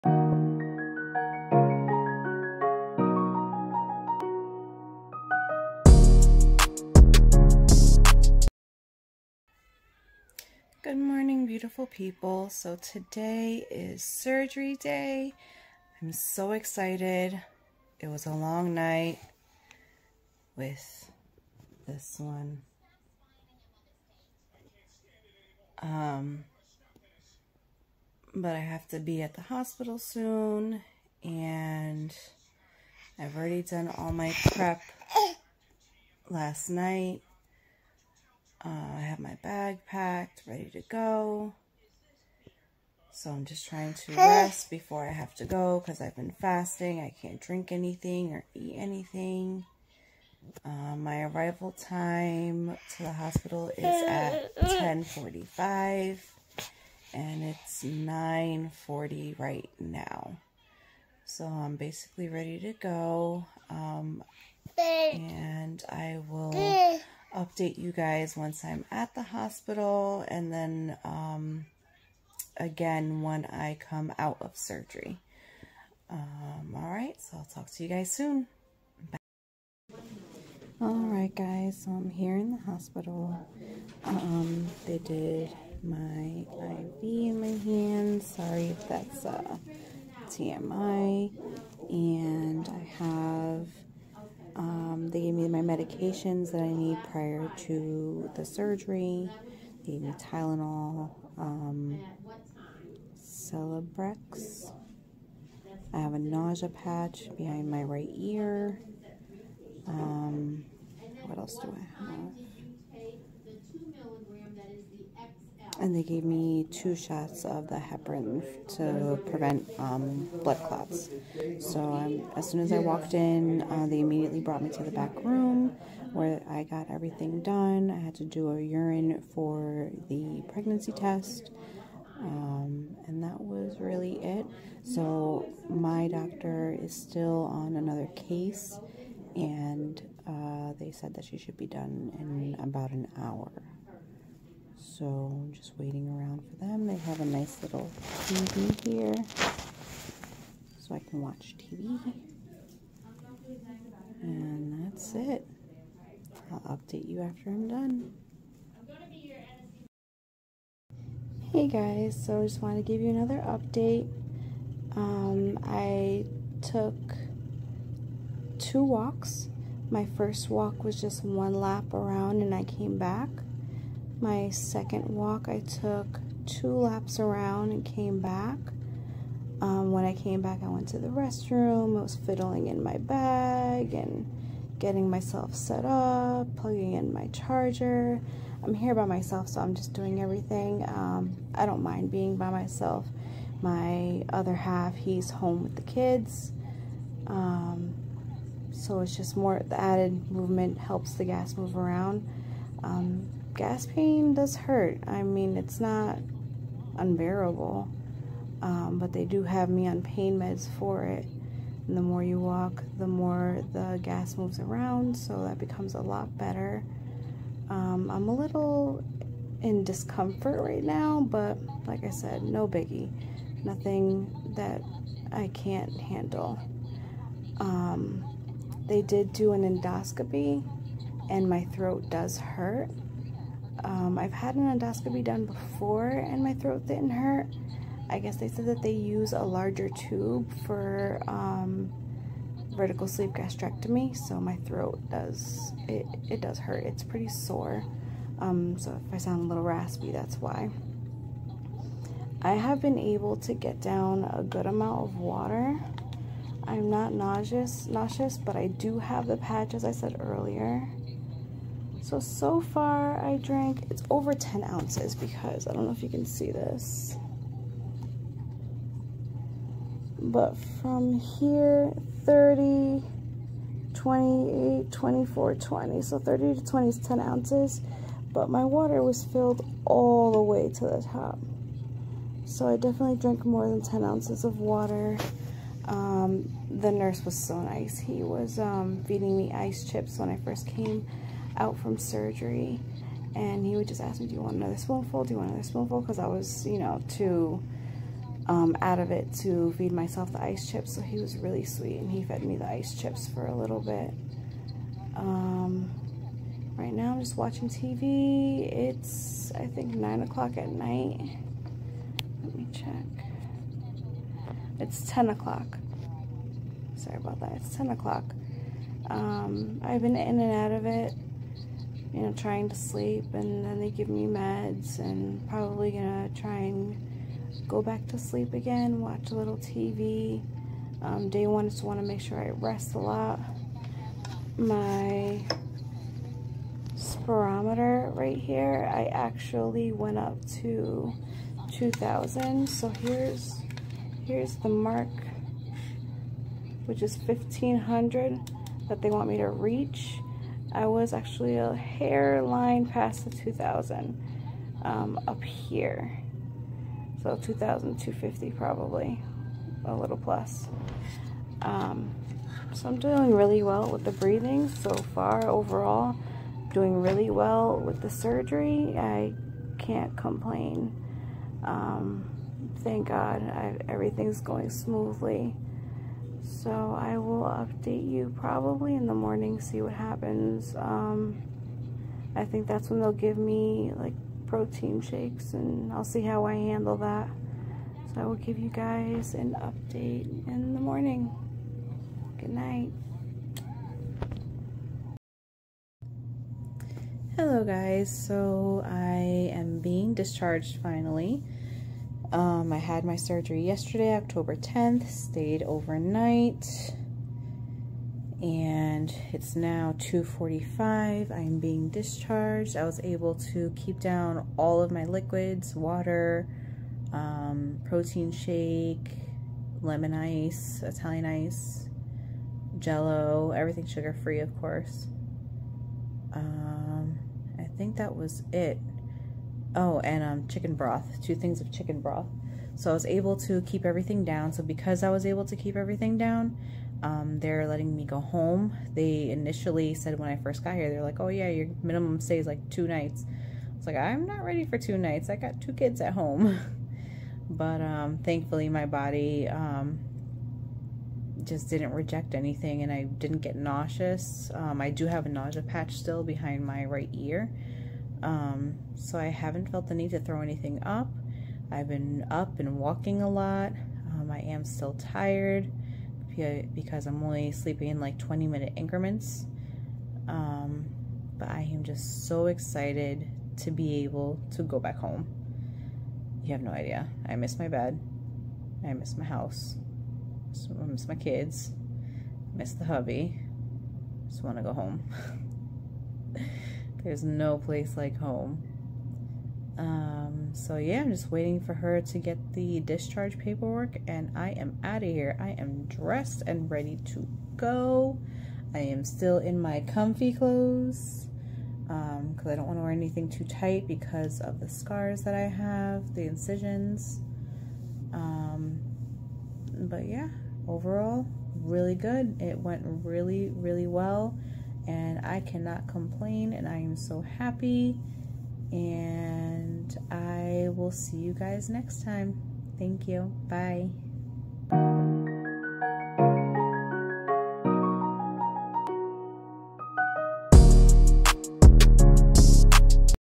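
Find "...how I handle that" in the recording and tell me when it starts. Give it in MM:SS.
06:26.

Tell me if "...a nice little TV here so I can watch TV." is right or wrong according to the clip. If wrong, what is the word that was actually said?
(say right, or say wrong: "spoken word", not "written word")
right.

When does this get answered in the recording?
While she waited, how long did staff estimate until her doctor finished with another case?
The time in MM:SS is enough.
02:22.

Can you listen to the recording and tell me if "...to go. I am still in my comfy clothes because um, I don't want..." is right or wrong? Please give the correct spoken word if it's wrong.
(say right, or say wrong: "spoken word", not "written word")
right.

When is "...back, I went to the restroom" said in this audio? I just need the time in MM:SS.
03:00.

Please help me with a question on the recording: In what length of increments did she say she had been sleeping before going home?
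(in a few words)
20 minutes.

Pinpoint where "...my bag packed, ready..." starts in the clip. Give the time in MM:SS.
00:39.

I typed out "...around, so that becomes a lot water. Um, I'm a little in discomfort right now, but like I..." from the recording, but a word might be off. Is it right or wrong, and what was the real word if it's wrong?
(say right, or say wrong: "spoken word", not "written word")
wrong: "better", not "water".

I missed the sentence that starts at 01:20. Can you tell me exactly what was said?
All right, guys, so I'm here in the hospital.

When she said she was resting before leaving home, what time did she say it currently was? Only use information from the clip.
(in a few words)
9:40.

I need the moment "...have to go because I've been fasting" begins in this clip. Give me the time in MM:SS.
00:45.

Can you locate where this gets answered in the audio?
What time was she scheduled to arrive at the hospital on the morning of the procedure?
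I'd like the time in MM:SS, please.
00:54.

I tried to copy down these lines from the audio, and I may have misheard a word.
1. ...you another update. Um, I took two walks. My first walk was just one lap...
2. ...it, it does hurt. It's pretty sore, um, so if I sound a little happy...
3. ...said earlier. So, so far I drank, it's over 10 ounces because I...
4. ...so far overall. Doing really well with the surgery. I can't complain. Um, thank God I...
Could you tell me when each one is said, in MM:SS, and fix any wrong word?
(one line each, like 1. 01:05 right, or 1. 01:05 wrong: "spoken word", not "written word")
1. 02:43 right
2. 04:05 wrong: "raspy", not "happy"
3. 04:19 right
4. 06:04 right.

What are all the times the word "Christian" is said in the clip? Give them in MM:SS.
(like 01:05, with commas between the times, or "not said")
not said.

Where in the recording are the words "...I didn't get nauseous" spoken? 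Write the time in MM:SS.
07:32.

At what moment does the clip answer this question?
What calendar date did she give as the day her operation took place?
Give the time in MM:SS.
06:44.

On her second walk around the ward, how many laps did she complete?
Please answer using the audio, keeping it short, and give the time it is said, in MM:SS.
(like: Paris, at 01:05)
2, at 02:56.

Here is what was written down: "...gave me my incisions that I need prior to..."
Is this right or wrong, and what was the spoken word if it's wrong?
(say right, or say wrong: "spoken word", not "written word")
wrong: "medications", not "incisions".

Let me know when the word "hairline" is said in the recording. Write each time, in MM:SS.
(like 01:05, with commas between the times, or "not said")
05:51.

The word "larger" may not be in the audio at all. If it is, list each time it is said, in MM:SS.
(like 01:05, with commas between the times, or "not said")
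03:59.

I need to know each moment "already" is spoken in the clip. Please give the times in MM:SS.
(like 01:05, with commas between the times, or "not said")
00:33.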